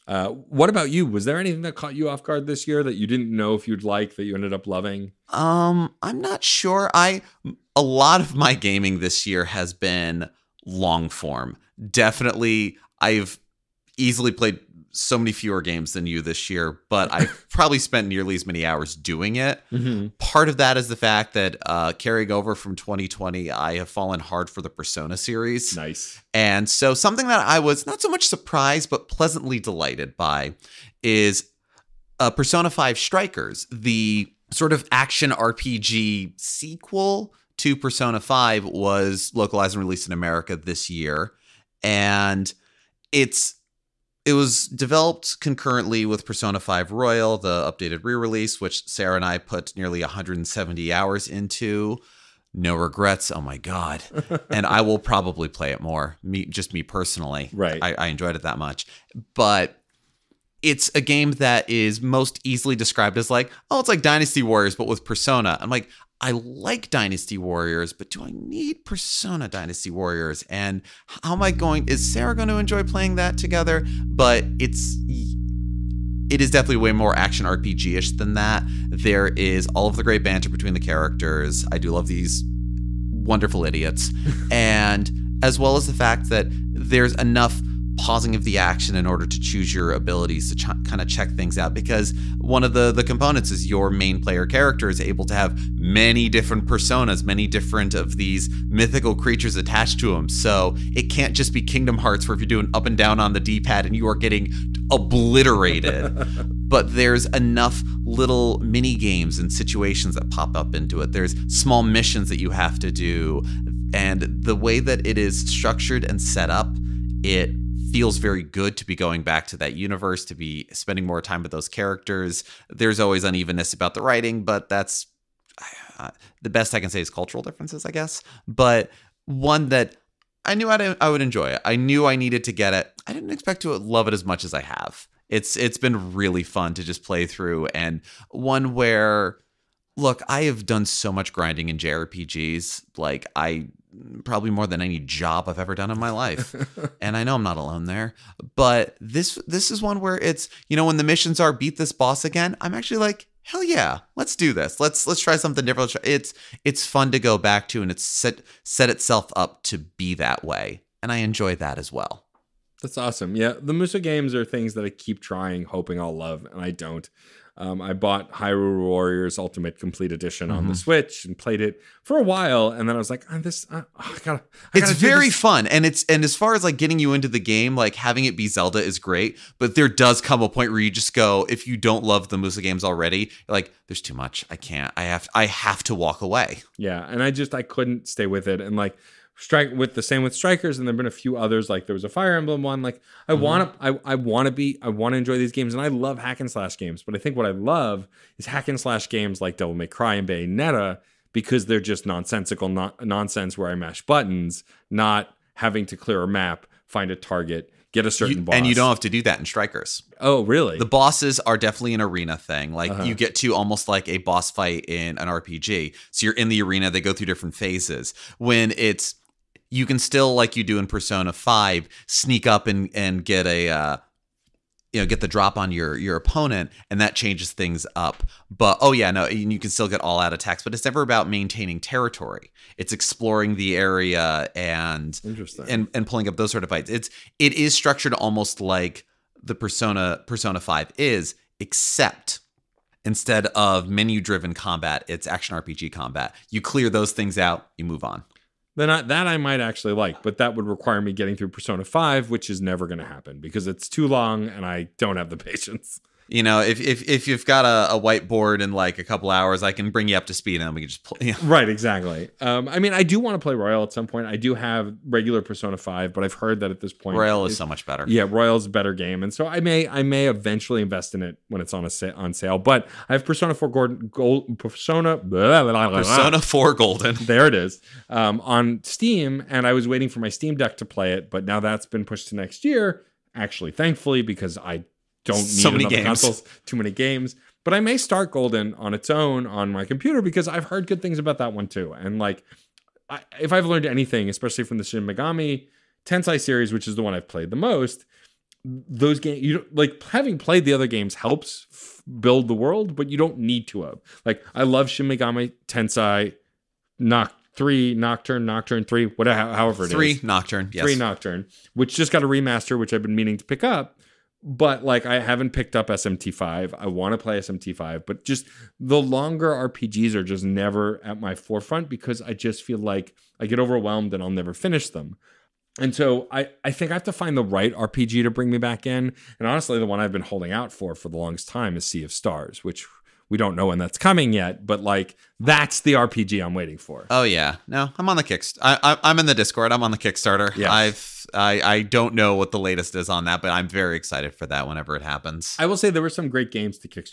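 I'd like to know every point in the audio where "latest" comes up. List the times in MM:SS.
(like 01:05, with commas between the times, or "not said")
05:42.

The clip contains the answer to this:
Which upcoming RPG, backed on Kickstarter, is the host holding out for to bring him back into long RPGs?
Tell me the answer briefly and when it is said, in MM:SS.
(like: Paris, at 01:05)
Sea of Stars, at 05:31.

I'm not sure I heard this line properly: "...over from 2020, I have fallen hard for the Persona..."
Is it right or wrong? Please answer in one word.
right.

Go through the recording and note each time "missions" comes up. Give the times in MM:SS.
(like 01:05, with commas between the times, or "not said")
01:51, 02:31.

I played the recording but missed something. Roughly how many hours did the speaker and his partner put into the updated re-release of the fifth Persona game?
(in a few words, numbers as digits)
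170.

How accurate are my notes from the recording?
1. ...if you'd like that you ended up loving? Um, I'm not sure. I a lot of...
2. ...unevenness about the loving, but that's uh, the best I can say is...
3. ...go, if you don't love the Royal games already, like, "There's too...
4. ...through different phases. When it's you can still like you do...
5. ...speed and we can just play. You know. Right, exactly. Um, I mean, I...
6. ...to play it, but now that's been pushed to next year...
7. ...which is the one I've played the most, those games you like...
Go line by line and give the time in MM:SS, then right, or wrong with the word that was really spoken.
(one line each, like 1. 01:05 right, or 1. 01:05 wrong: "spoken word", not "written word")
1. 00:03 right
2. 02:03 wrong: "writing", not "loving"
3. 03:01 wrong: "Musou", not "Royal"
4. 03:37 right
5. 04:20 right
6. 04:40 right
7. 04:56 right.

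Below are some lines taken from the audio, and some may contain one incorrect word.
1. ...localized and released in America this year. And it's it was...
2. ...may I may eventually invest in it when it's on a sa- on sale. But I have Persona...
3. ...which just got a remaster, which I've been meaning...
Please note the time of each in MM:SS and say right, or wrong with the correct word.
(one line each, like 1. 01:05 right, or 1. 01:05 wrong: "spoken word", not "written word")
1. 00:39 right
2. 04:29 right
3. 05:11 right.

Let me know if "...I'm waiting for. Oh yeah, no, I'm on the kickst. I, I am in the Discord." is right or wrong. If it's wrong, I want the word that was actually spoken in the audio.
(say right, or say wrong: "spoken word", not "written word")
right.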